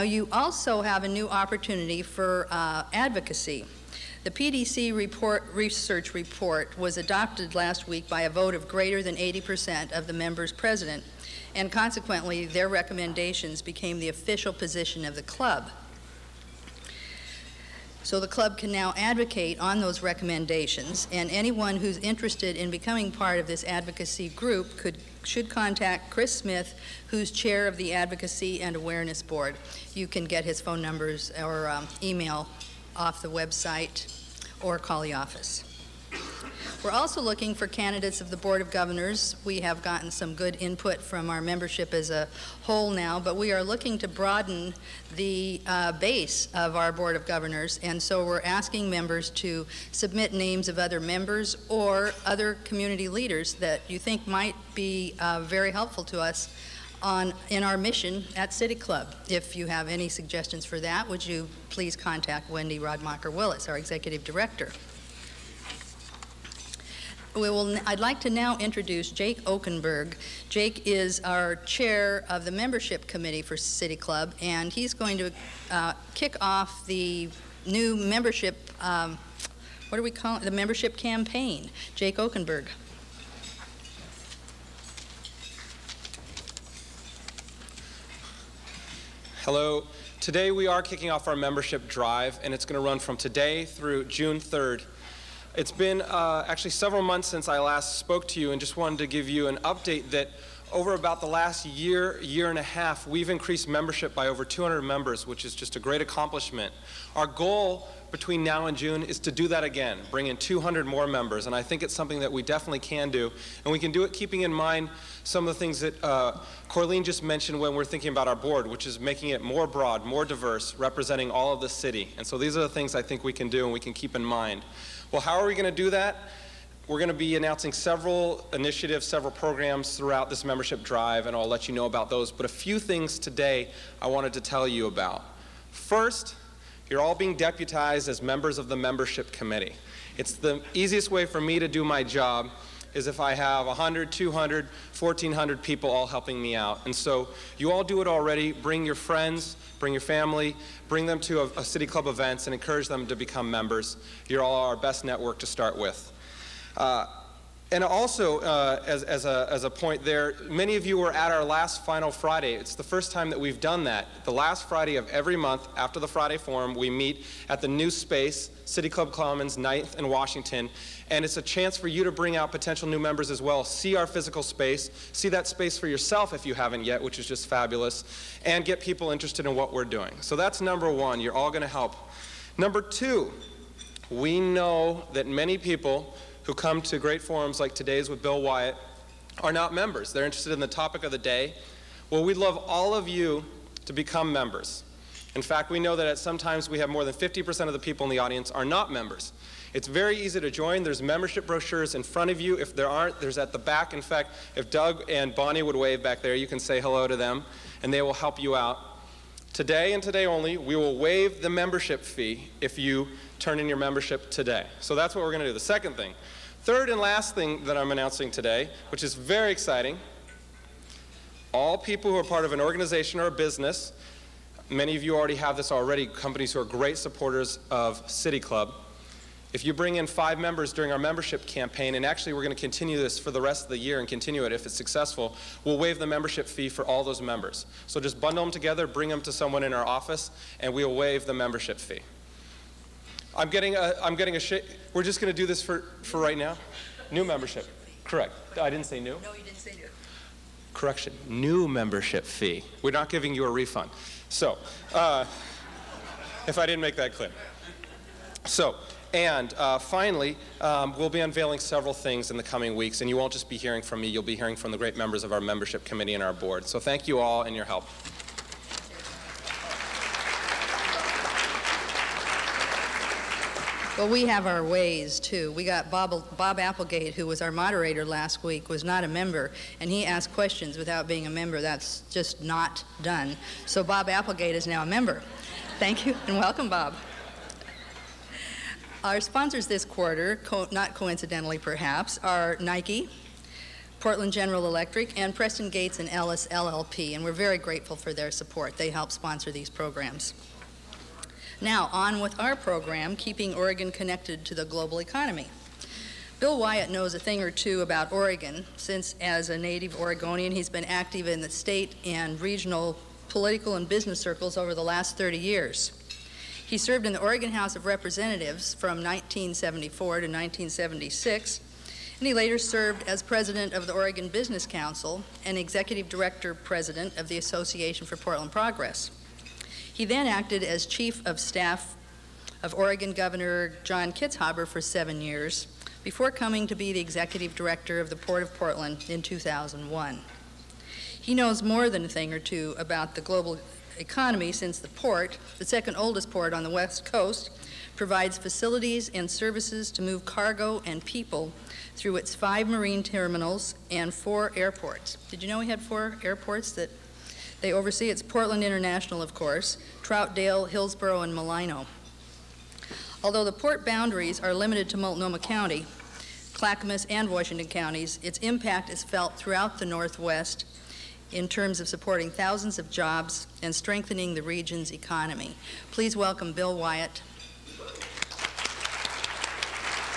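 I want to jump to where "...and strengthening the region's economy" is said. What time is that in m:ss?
6:13.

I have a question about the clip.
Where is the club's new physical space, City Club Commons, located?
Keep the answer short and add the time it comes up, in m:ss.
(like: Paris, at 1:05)
9th and Washington, at 2:49.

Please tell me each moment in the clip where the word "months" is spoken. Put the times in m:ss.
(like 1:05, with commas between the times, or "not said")
1:37, 2:45.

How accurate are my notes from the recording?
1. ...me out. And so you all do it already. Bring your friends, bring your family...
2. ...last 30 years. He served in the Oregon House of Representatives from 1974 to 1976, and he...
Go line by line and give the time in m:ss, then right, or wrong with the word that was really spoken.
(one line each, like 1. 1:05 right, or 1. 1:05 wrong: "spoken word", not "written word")
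1. 2:26 right
2. 5:14 right.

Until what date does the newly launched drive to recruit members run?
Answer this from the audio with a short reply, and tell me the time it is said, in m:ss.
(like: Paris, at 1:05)
June 3rd, at 1:34.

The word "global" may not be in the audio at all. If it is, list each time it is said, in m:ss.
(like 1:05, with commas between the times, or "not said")
5:04, 5:43.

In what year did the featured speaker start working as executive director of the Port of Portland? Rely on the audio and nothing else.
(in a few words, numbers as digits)
2001.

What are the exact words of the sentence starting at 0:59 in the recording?
If you have any suggestions for that, would you please contact Wendy Radmacher Willis, our executive director.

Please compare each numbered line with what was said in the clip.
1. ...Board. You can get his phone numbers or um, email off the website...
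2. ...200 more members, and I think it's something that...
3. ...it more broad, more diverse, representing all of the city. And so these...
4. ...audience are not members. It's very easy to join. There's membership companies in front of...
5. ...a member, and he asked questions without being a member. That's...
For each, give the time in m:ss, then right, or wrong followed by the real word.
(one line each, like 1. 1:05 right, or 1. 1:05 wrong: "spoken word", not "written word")
1. 0:29 right
2. 1:50 right
3. 1:59 right
4. 3:18 wrong: "brochures", not "companies"
5. 4:39 right.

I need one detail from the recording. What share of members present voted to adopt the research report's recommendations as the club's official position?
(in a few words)
greater than 80%.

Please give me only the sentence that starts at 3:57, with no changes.
So just bundle them together, bring them to someone in our office, and we'll waive the membership fee.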